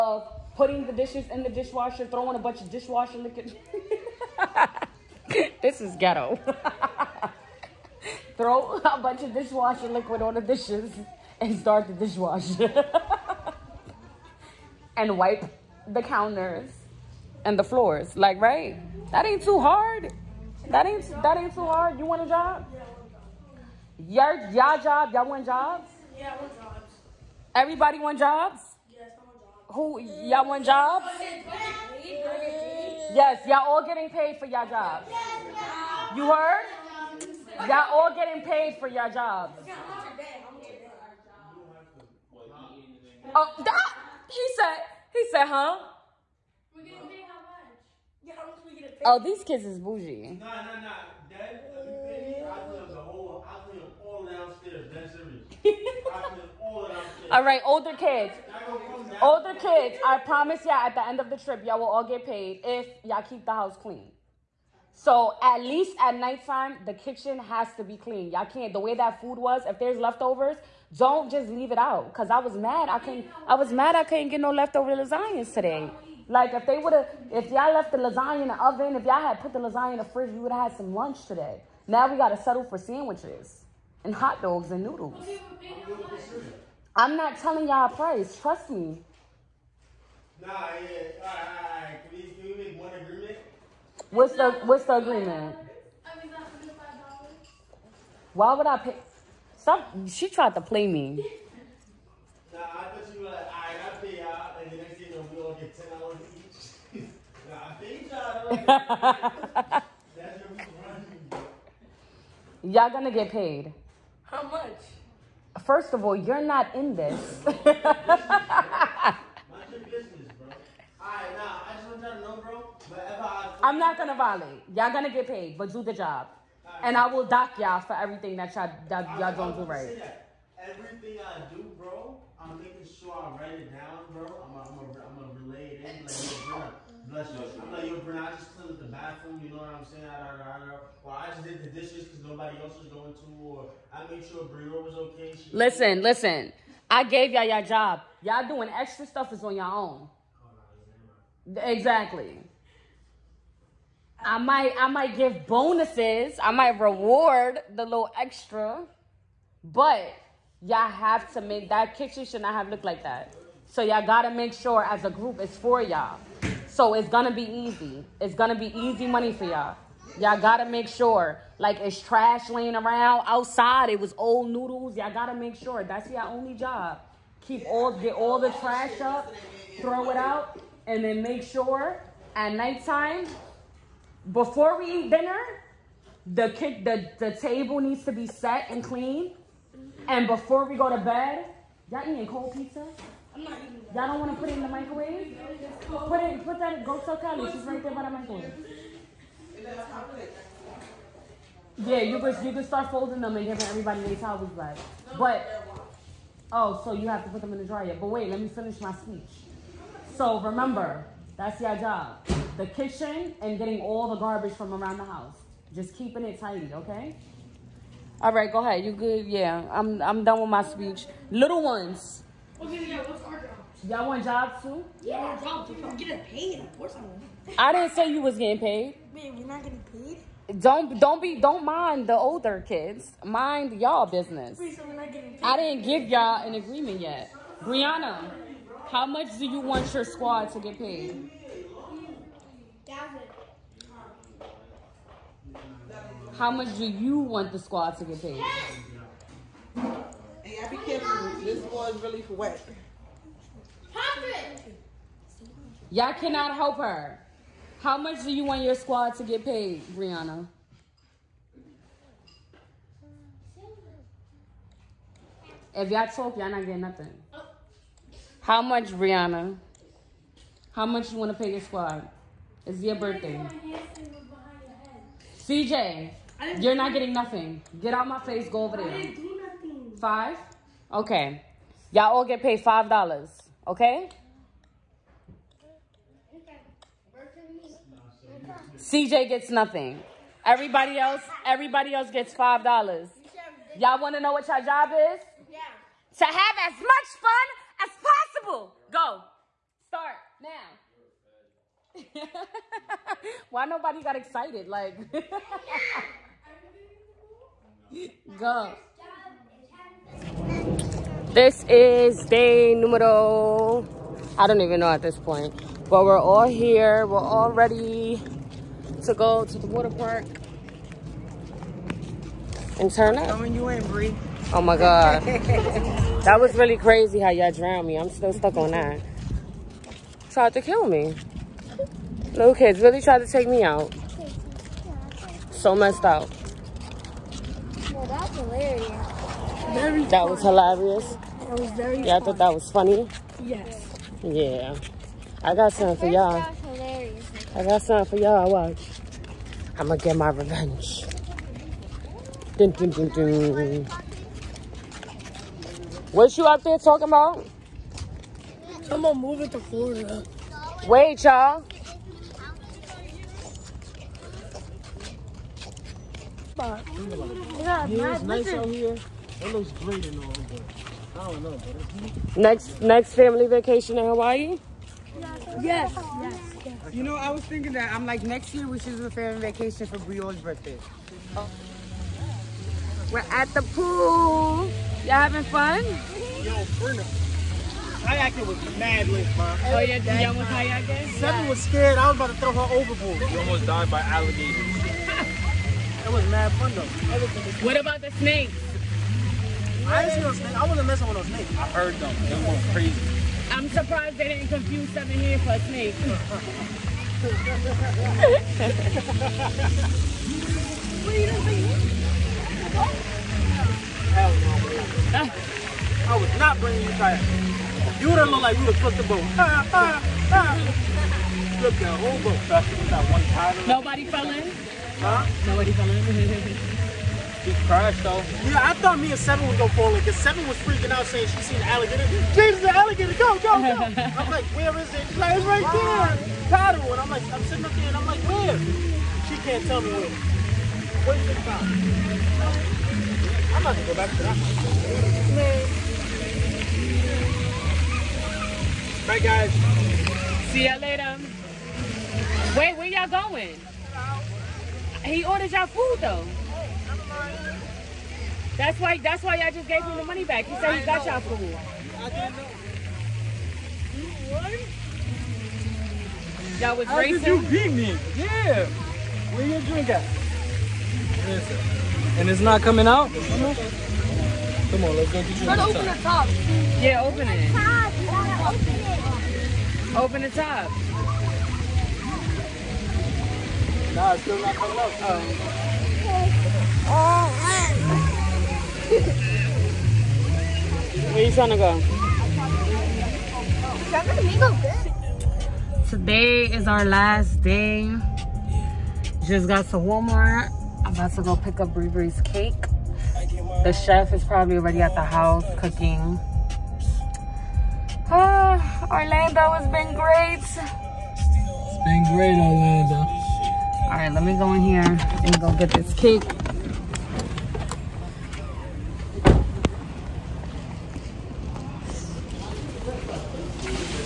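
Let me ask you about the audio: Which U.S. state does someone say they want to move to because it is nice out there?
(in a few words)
Florida.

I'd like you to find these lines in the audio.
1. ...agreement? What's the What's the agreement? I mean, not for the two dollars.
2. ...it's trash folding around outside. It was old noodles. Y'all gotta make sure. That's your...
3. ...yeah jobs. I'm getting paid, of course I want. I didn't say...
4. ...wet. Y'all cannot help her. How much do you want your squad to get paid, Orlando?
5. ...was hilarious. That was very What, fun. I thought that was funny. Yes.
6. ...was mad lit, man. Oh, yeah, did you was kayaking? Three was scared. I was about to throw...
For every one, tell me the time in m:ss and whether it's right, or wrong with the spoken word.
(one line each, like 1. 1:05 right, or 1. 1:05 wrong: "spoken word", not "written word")
1. 1:32 wrong: "five", not "two"
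2. 2:51 wrong: "laying", not "folding"
3. 3:45 right
4. 4:12 wrong: "Briana", not "Orlando"
5. 5:40 wrong: "Yeah", not "What"
6. 6:28 wrong: "Seven", not "Three".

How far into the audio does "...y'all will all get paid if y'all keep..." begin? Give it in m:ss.
1:01.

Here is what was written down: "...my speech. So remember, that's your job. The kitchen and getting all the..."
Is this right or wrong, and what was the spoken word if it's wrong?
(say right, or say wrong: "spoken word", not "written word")
right.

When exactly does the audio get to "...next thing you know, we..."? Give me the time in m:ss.
1:44.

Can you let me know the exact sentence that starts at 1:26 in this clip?
I'm not telling y'all a price.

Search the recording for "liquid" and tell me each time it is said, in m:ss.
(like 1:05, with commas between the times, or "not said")
0:03, 0:09.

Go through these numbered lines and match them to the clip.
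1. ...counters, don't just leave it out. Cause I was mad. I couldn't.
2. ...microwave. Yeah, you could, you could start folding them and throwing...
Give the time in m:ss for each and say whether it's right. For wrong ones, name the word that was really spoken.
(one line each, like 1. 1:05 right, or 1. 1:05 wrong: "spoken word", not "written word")
1. 1:09 wrong: "leftovers", not "counters"
2. 3:18 wrong: "giving", not "throwing".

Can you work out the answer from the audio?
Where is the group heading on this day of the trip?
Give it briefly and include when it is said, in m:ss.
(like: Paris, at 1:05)
The water park, at 5:19.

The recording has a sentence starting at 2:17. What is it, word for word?
I'm like, yo, Brian, I just cleaned the bathroom, you know what I'm saying?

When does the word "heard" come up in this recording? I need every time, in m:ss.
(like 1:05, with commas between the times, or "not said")
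0:36, 6:41.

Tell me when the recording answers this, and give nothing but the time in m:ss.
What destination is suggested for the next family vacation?
6:14.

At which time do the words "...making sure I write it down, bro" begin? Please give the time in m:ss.
2:12.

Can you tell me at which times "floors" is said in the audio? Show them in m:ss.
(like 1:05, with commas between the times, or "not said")
0:17.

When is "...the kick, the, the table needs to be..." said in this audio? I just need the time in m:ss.
3:06.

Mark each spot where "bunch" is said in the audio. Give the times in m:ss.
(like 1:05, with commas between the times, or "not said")
0:02, 0:09.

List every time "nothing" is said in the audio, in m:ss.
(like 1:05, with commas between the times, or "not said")
4:26, 4:37, 4:49.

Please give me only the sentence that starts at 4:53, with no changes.
Y'all want to know what y'all job is?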